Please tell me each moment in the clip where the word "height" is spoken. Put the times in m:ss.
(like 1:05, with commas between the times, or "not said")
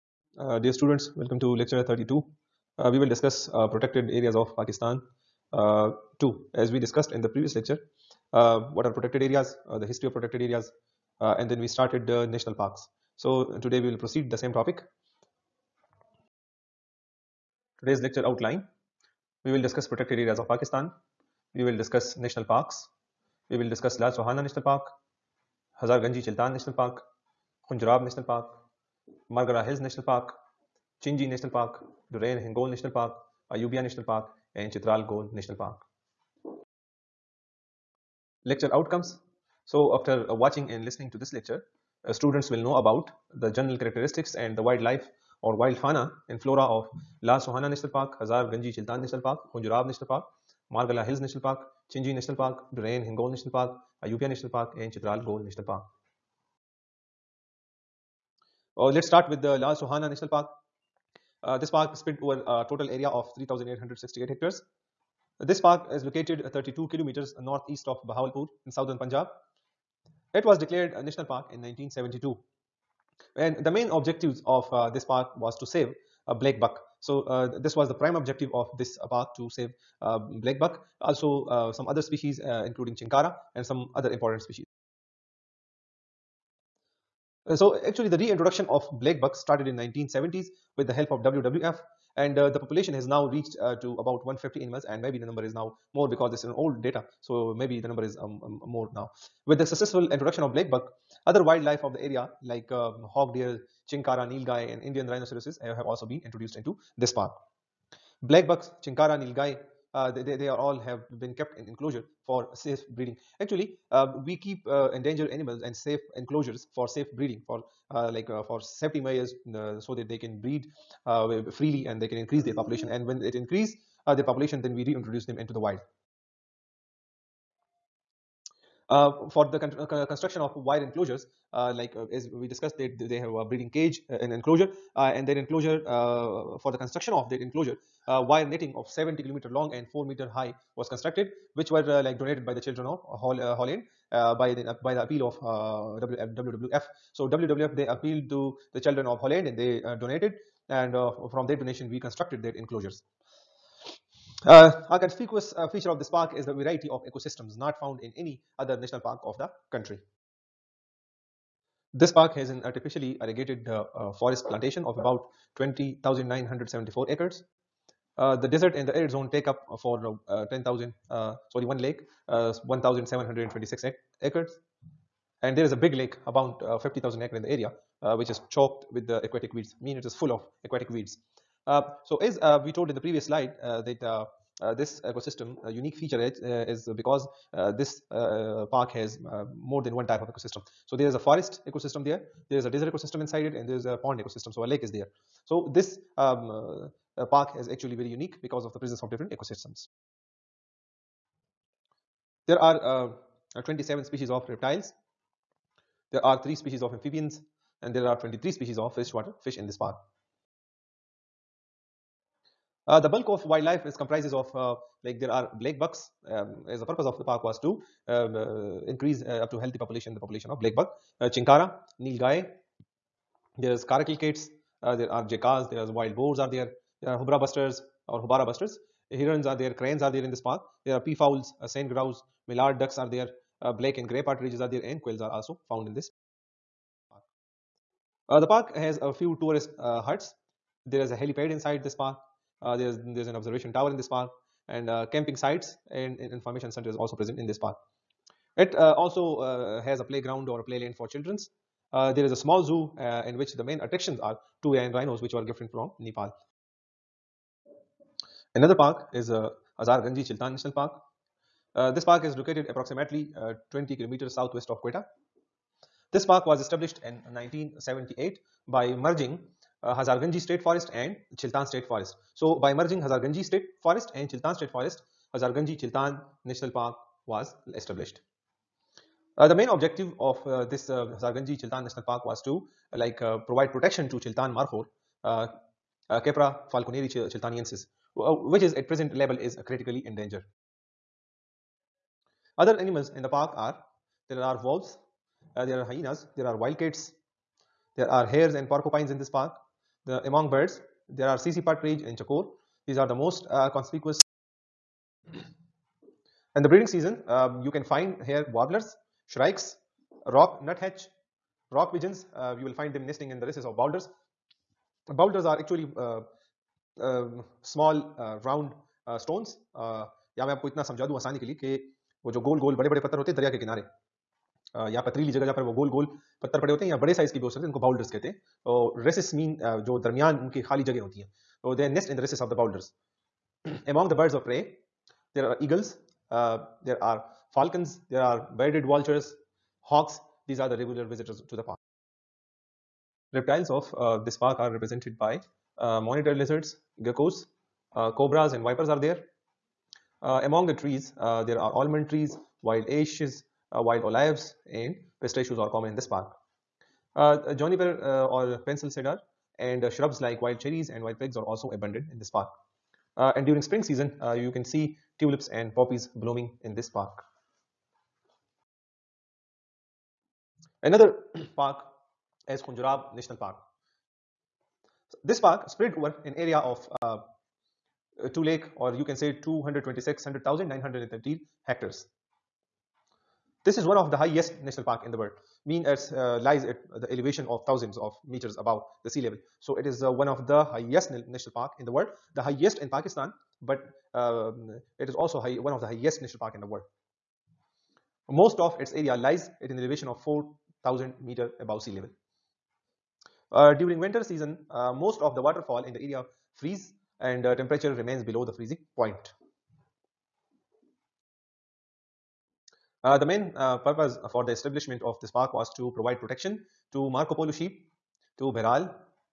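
not said.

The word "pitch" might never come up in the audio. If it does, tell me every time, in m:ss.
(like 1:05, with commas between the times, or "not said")
not said.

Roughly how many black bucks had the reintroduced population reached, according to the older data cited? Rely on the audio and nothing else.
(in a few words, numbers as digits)
150.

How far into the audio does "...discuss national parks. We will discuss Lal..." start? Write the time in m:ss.
0:21.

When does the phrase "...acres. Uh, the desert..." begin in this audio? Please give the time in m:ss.
2:47.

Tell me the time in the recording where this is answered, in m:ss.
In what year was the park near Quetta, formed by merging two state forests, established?
4:27.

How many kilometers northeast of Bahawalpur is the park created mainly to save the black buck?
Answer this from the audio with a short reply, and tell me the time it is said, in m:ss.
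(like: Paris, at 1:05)
32 kilometers, at 1:06.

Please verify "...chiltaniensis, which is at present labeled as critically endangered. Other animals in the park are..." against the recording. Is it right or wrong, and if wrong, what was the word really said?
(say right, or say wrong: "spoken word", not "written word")
right.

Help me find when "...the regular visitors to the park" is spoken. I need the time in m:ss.
5:40.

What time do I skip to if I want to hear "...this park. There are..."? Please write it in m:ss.
3:50.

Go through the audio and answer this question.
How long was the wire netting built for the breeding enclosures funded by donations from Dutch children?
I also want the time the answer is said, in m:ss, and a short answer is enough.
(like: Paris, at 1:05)
70 kilometers, at 2:18.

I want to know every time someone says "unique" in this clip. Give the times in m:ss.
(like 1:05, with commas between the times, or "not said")
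3:05, 3:18.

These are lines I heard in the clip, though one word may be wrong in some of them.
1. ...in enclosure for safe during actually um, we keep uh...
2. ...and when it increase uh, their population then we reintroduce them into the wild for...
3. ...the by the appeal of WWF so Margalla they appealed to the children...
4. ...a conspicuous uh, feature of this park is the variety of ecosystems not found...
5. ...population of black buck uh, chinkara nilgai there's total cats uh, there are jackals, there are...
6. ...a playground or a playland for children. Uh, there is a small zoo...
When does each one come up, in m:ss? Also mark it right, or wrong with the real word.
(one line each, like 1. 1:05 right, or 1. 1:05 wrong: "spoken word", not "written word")
1. 1:51 wrong: "breeding", not "during"
2. 2:02 right
3. 2:24 wrong: "WWF", not "Margalla"
4. 2:34 right
5. 3:40 wrong: "caracal", not "total"
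6. 4:09 right.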